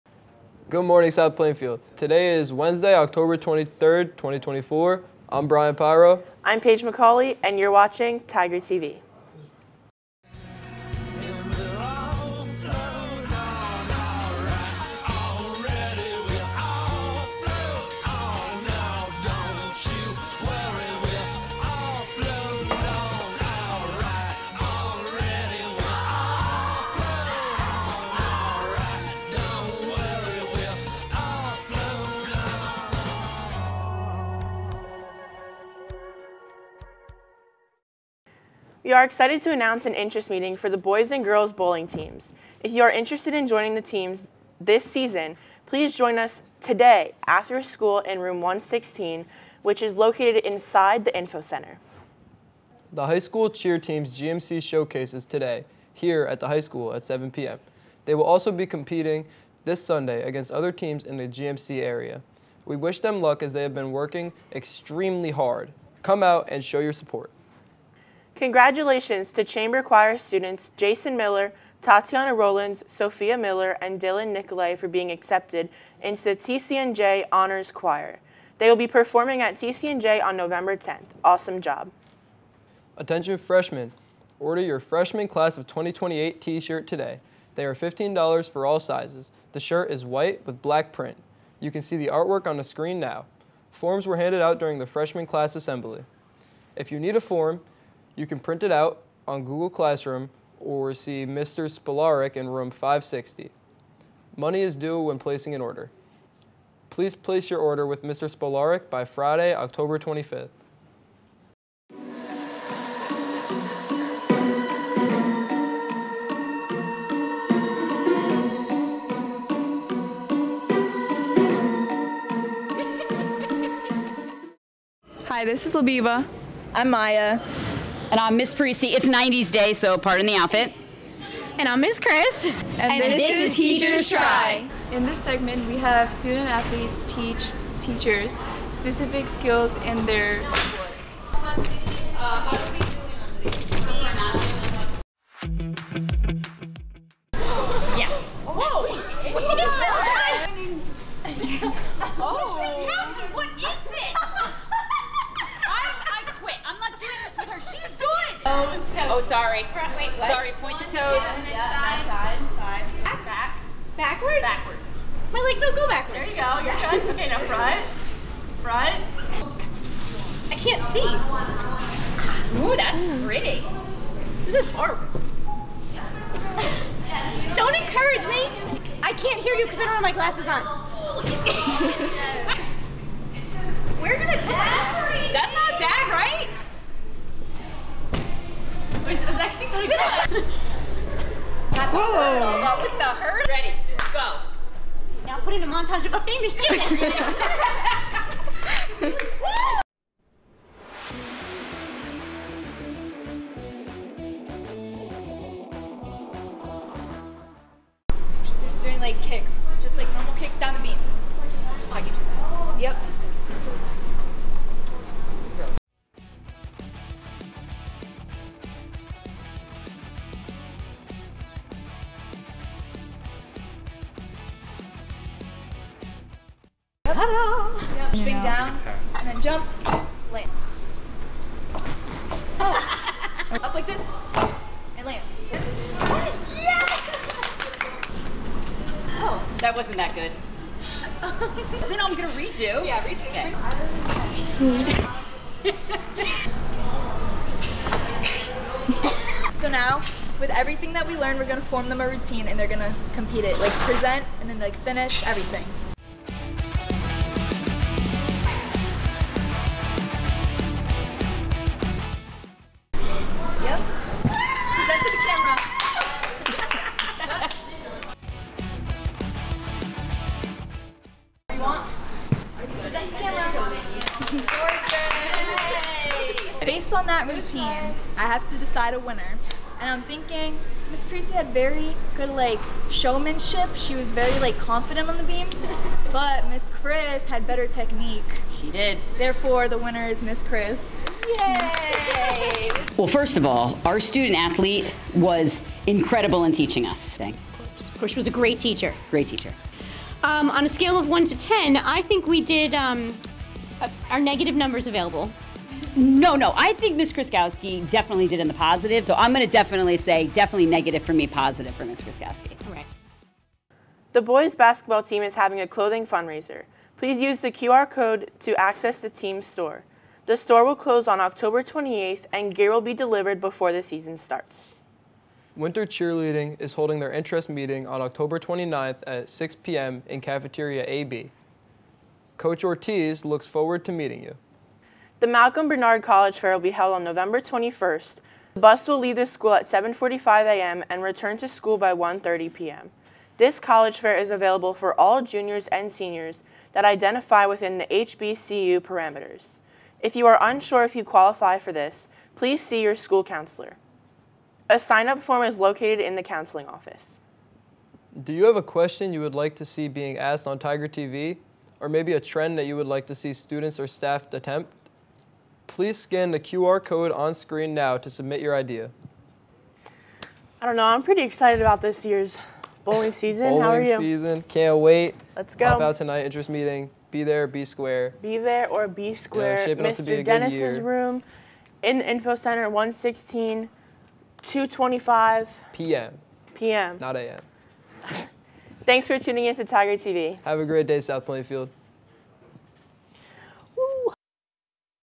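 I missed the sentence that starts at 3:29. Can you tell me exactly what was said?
like kicks, just like normal kicks down the beam.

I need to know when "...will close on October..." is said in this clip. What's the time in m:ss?
5:20.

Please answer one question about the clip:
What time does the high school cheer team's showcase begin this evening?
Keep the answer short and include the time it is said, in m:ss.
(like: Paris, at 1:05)
7 p.m., at 0:57.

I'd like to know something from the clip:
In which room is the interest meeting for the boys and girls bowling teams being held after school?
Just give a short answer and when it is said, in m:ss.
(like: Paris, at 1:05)
Room 116, at 0:48.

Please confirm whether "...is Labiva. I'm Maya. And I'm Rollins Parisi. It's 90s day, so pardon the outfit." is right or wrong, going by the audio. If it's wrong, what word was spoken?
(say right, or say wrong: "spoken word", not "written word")
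wrong: "Miss", not "Rollins".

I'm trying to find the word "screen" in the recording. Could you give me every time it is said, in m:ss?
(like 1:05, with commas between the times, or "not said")
1:32, 6:07.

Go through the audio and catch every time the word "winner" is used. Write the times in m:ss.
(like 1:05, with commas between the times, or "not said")
4:38, 4:49.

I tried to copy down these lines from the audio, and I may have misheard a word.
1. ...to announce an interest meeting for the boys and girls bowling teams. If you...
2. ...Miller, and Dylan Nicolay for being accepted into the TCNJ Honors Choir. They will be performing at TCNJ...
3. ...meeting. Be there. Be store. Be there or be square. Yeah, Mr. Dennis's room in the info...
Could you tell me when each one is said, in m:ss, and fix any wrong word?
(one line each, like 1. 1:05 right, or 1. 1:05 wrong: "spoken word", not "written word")
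1. 0:39 right
2. 1:13 right
3. 6:16 wrong: "square", not "store".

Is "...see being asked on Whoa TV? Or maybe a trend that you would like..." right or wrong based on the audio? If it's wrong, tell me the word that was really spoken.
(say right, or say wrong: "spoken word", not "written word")
wrong: "Tiger", not "Whoa".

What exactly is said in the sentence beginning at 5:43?
This college fair is available for all juniors and seniors that identify within the HBCU parameters.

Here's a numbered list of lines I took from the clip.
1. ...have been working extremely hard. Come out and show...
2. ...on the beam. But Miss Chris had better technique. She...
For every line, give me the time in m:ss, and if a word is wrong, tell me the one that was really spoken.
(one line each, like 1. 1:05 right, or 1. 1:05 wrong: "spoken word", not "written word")
1. 1:03 right
2. 4:45 right.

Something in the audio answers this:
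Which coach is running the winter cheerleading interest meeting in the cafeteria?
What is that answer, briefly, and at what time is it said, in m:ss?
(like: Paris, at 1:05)
Coach Ortiz, at 5:32.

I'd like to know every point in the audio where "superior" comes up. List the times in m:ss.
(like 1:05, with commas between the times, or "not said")
not said.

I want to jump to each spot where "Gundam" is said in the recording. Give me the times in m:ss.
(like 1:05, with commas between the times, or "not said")
not said.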